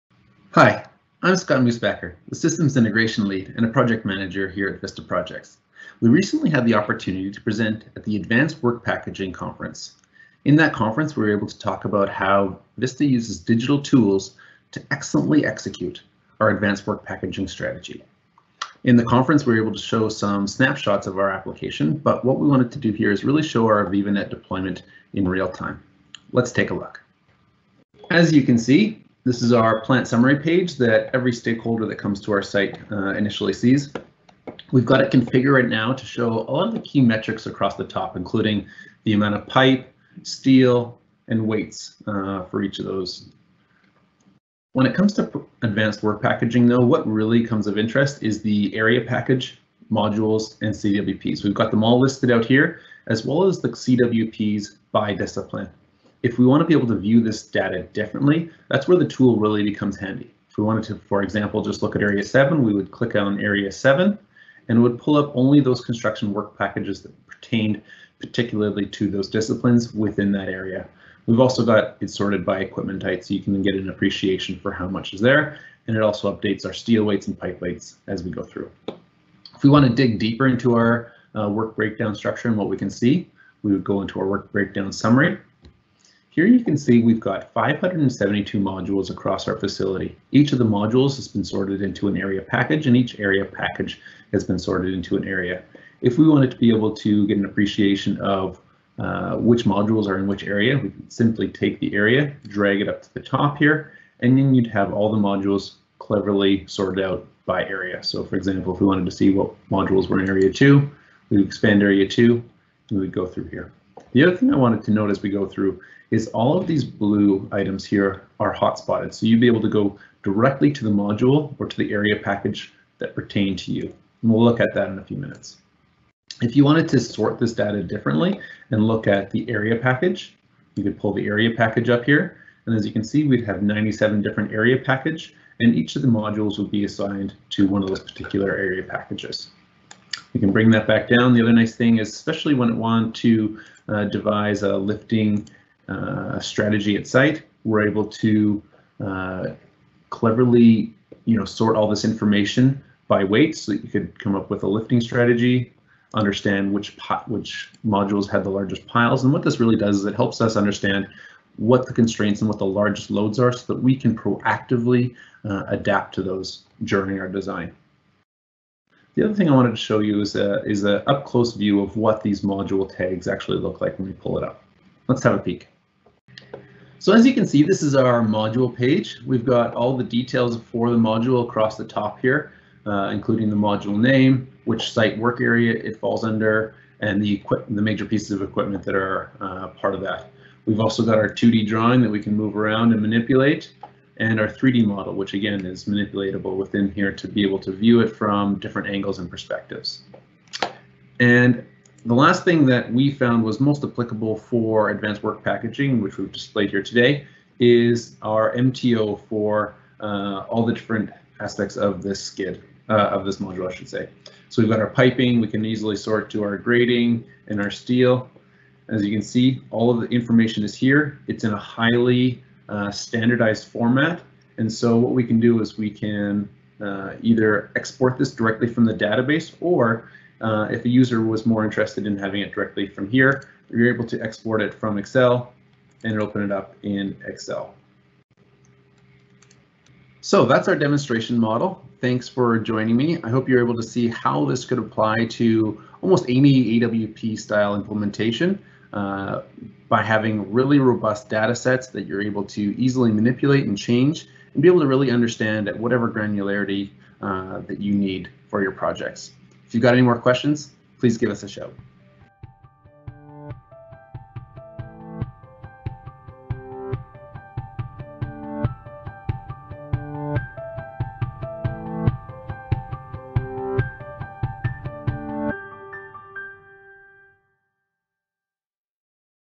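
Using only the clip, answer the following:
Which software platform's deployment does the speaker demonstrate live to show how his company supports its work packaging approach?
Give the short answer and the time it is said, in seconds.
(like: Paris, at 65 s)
AVEVA NET, at 23 s.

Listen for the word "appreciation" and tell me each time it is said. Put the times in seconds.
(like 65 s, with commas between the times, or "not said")
73 s, 97 s.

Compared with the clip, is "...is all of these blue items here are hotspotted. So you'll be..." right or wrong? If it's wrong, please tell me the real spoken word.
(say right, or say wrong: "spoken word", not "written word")
right.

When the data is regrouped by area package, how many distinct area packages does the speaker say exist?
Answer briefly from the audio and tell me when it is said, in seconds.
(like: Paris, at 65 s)
97, at 133 s.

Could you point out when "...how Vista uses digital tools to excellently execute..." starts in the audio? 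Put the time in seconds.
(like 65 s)
12 s.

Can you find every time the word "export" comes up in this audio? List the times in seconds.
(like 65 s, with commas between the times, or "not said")
227 s, 234 s.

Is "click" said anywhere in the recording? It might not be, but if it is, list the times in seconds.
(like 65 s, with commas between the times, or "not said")
62 s.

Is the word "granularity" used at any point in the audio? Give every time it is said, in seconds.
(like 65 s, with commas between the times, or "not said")
256 s.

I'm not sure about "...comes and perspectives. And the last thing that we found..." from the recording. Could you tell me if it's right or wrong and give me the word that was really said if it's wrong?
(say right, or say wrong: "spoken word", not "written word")
wrong: "angles", not "comes".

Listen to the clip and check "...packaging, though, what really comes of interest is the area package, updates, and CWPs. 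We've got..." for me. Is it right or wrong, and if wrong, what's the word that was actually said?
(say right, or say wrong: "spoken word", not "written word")
wrong: "modules", not "updates".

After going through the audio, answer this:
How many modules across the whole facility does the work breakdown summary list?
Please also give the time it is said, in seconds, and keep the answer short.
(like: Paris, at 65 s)
572, at 87 s.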